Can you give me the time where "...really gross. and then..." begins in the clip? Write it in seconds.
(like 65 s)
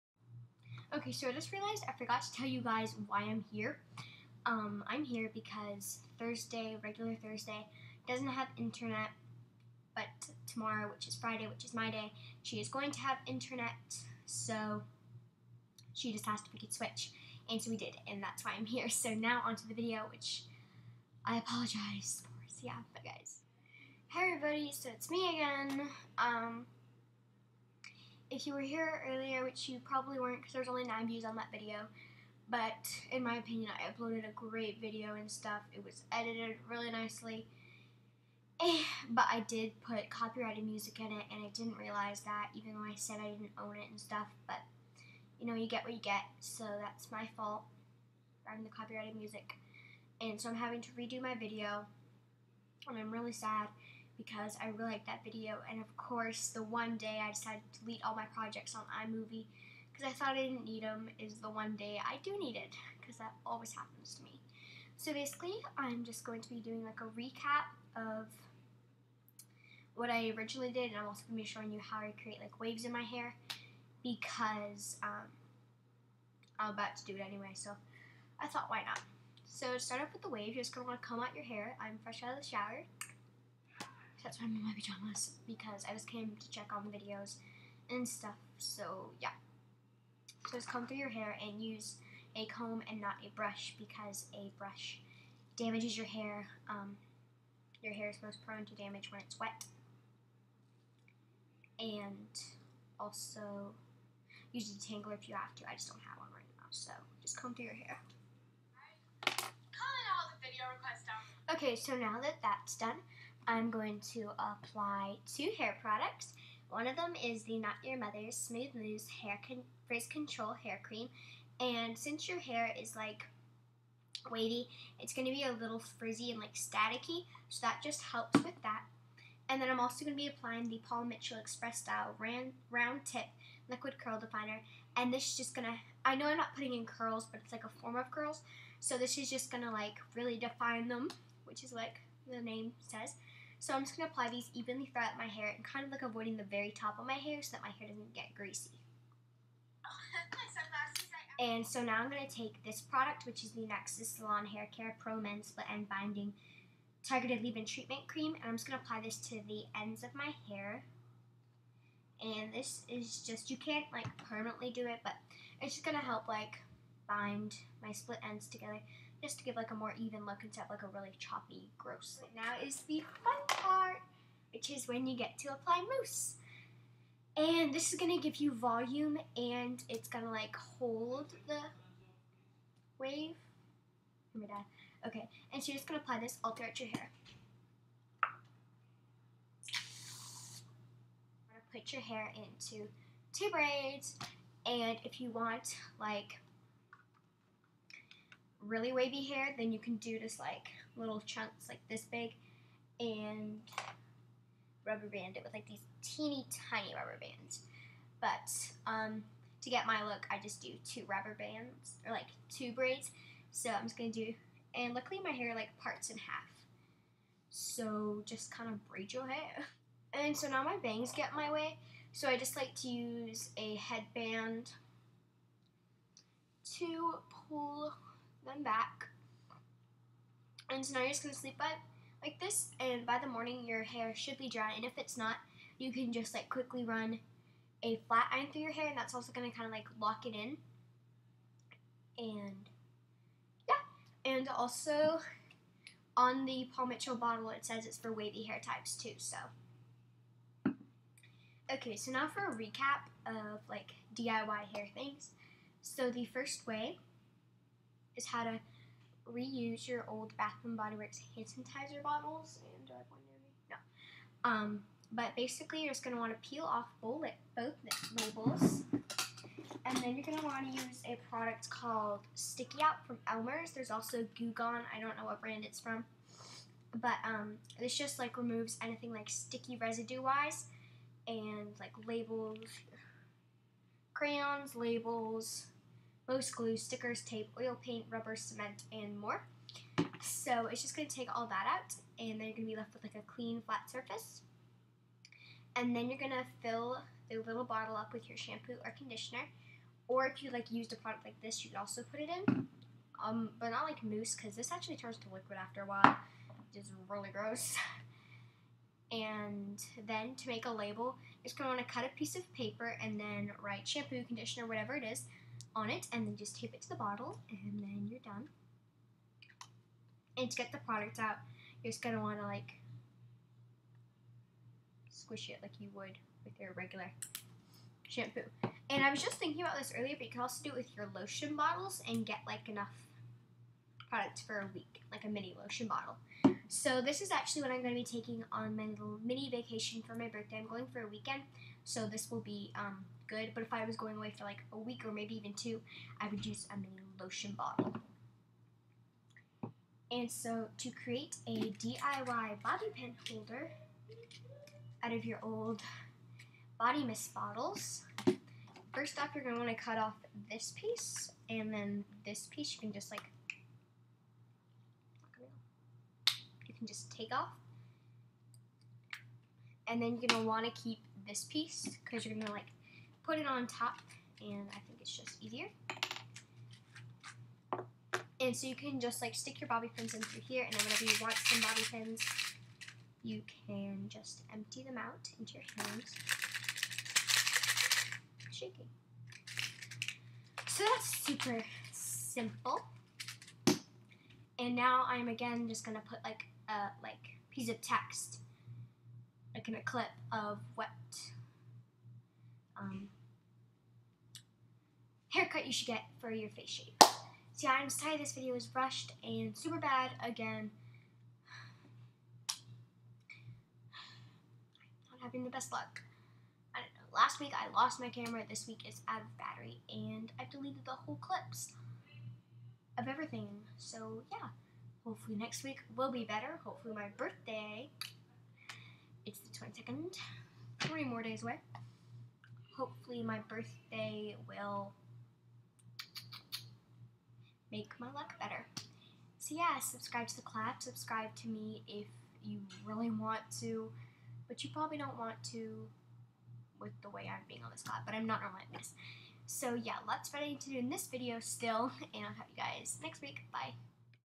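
307 s.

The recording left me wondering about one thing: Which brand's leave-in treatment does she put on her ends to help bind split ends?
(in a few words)
Nexxus.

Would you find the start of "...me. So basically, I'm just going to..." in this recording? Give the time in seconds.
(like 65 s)
64 s.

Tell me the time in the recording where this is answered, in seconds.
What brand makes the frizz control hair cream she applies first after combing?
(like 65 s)
117 s.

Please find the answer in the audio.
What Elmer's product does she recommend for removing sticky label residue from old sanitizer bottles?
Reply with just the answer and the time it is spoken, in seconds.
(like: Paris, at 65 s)
Sticky Out, at 272 s.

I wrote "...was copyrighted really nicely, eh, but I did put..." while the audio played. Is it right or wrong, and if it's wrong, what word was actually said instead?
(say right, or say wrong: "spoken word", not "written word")
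wrong: "edited", not "copyrighted".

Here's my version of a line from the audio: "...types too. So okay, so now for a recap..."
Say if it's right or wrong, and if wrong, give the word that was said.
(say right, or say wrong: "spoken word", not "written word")
right.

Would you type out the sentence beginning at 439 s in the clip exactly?
So yeah, subscribe to the collab.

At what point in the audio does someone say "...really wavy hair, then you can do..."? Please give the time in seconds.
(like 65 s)
198 s.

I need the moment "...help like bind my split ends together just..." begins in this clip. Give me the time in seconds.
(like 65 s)
166 s.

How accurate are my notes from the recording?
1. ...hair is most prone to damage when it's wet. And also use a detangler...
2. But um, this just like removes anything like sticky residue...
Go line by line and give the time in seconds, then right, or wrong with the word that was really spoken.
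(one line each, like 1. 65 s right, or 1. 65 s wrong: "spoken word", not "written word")
1. 97 s right
2. 276 s right.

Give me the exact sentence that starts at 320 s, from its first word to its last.
And to get the product out, you're just going to want to like squish it like you would with your regular shampoo.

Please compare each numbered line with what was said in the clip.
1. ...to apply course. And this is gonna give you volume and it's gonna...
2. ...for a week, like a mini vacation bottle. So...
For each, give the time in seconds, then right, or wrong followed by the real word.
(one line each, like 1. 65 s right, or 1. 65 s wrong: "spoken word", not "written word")
1. 175 s wrong: "mousse", not "course"
2. 334 s wrong: "lotion", not "vacation".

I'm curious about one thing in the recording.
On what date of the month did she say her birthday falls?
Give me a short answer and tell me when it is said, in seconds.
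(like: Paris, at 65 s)
22nd, at 429 s.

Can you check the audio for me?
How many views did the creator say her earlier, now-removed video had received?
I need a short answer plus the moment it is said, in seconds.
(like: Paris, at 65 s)
9, at 30 s.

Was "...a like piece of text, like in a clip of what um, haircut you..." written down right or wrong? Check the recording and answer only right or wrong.
right.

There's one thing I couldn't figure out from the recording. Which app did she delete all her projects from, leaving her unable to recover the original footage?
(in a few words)
iMovie.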